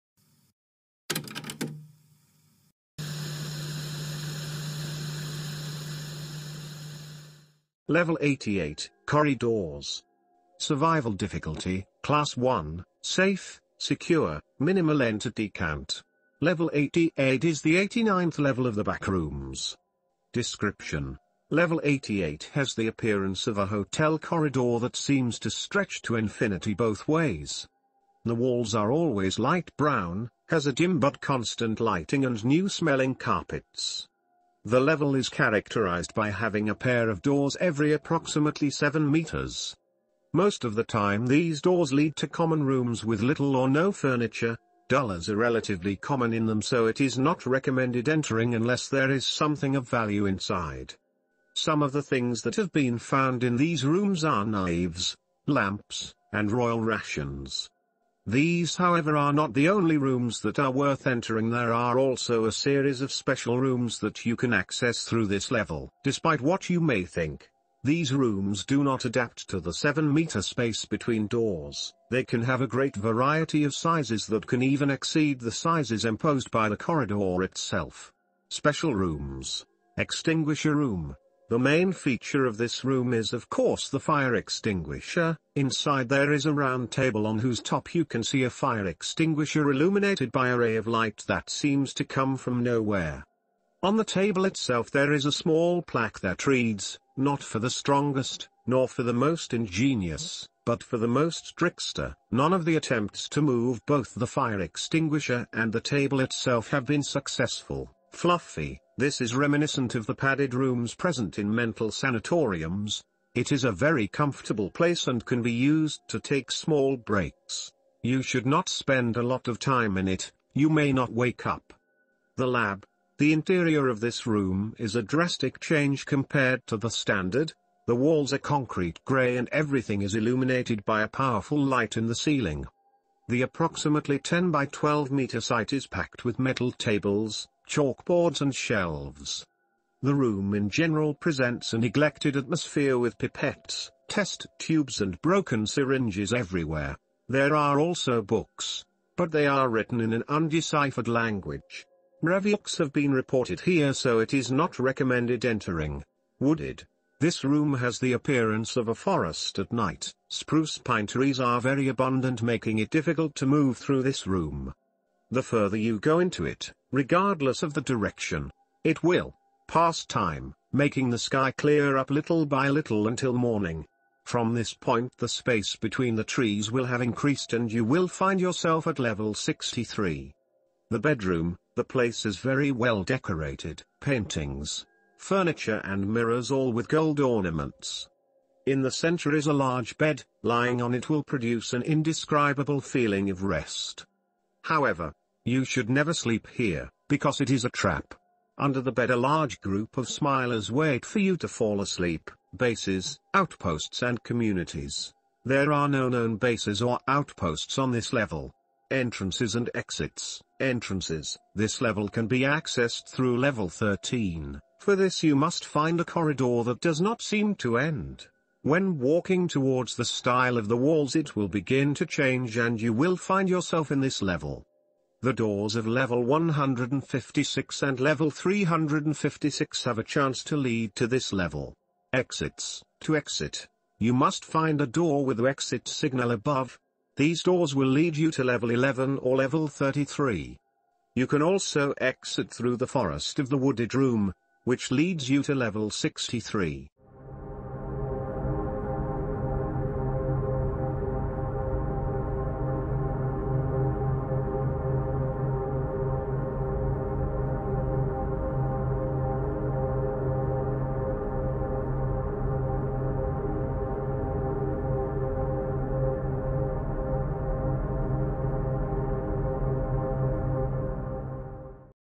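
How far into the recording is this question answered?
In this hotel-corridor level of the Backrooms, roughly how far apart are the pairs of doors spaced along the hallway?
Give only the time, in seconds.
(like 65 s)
38 s.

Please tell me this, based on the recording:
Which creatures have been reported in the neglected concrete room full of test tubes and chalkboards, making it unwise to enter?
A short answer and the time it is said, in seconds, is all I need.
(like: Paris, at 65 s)
Mraviuks, at 152 s.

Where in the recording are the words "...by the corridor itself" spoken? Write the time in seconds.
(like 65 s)
76 s.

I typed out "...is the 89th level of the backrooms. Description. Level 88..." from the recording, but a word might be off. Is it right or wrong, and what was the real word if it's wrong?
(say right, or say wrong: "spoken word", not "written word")
right.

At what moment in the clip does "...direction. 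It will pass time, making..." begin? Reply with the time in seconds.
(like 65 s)
167 s.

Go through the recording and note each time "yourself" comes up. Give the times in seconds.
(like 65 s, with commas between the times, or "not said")
178 s, 223 s.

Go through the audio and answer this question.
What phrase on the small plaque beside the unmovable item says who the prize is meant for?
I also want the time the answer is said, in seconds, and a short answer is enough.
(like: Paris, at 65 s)
the most trickster, at 100 s.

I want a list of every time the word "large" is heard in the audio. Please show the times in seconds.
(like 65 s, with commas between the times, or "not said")
189 s, 199 s.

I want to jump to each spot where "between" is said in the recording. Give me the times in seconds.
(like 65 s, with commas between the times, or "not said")
70 s, 175 s.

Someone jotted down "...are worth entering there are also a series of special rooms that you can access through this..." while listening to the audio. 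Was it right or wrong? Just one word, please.
right.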